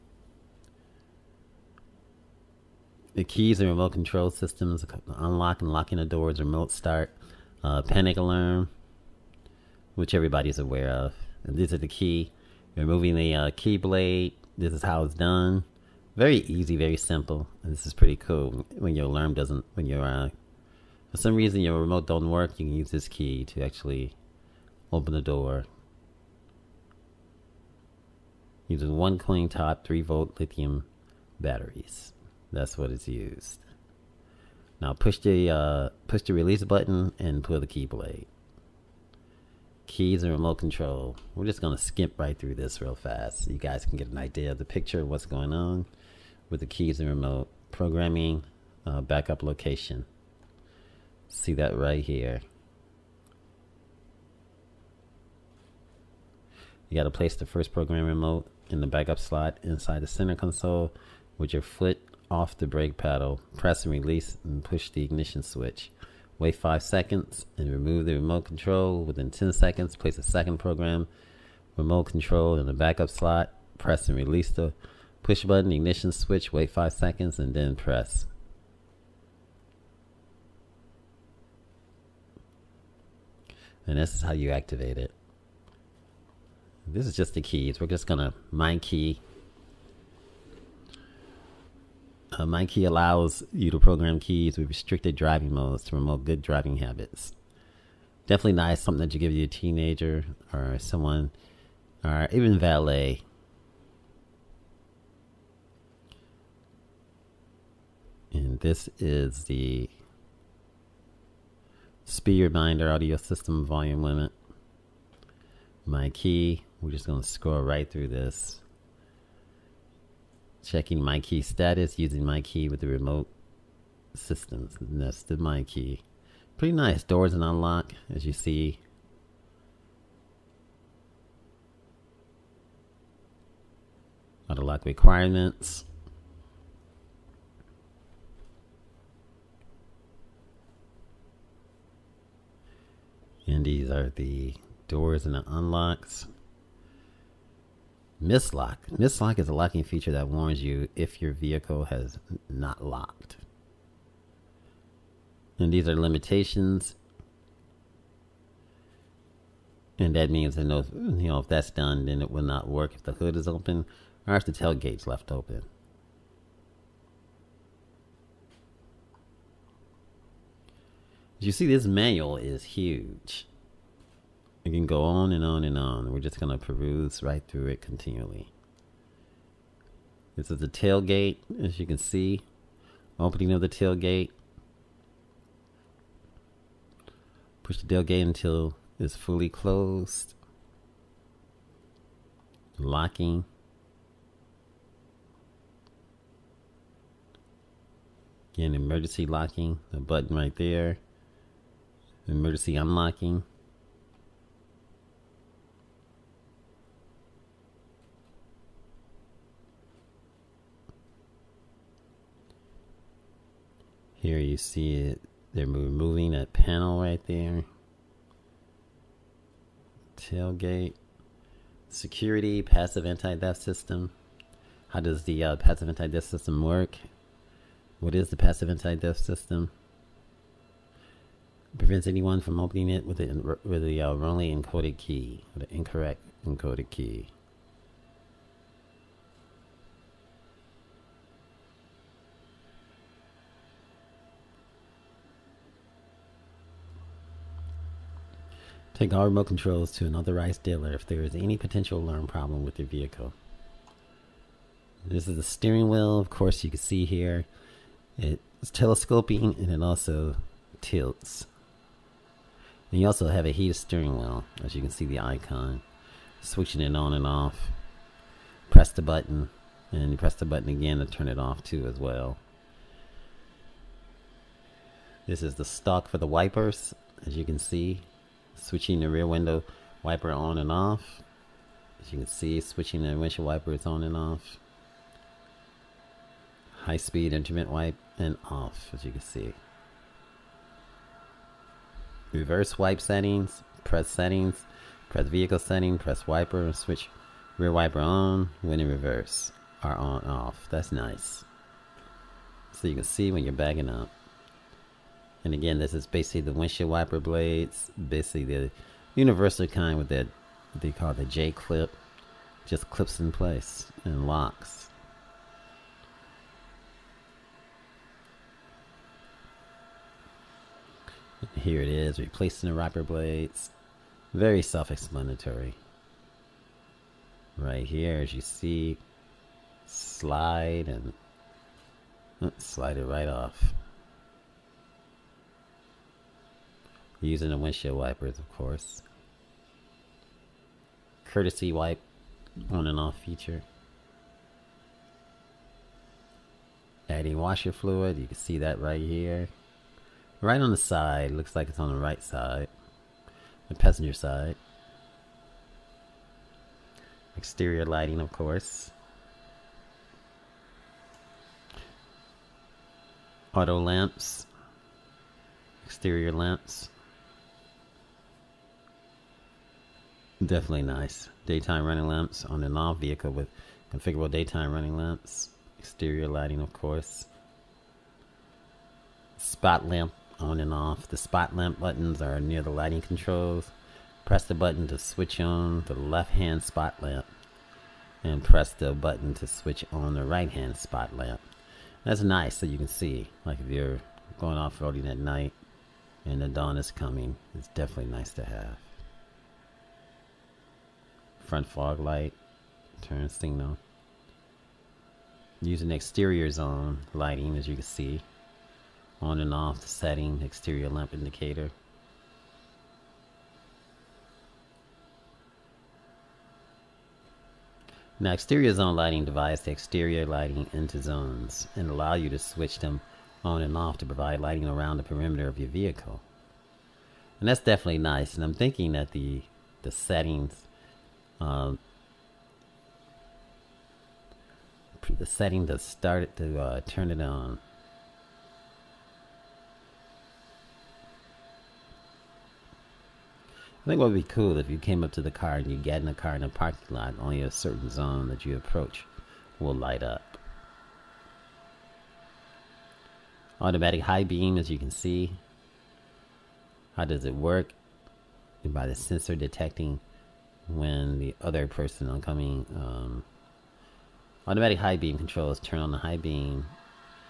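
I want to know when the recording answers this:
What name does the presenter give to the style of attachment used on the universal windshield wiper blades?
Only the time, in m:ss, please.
5:11.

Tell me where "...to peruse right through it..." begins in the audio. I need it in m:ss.
2:56.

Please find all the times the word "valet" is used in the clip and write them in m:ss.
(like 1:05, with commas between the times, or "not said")
1:42.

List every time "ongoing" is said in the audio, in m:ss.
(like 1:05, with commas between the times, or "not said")
not said.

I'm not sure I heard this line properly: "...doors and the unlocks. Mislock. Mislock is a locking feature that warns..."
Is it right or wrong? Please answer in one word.
right.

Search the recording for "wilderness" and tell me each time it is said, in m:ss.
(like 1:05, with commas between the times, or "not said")
not said.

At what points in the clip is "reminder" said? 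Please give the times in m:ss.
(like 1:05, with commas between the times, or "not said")
1:52.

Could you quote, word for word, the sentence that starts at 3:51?
prevents anyone from opening it with the with a uh, wrongly encoded key, with the incorrect encoded key.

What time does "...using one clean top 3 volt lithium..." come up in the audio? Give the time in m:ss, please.
0:28.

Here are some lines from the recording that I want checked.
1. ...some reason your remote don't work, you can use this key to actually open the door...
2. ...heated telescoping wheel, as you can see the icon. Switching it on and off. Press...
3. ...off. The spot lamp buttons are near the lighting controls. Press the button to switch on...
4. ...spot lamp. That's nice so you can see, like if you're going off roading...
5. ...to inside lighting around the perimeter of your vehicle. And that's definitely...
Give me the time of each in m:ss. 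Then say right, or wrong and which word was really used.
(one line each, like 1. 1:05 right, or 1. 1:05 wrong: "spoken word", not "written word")
1. 0:21 right
2. 4:23 wrong: "steering", not "telescoping"
3. 6:20 right
4. 6:30 right
5. 7:03 wrong: "provide", not "inside".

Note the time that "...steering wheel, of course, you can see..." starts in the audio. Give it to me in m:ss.
4:15.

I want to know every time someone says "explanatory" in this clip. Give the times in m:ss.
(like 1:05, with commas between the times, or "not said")
5:24.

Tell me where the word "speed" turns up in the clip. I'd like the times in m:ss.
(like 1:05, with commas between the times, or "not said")
1:52, 4:46.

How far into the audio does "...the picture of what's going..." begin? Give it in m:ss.
0:44.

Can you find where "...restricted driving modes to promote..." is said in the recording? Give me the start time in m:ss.
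1:34.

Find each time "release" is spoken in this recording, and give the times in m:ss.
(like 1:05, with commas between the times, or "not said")
0:36, 1:03, 1:14.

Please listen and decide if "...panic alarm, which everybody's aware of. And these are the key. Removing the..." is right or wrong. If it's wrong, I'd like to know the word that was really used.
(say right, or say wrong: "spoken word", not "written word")
right.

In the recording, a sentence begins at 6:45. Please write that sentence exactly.
Using exterior zone lighting as you can see.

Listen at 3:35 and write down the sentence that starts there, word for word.
They're removing that panel right there.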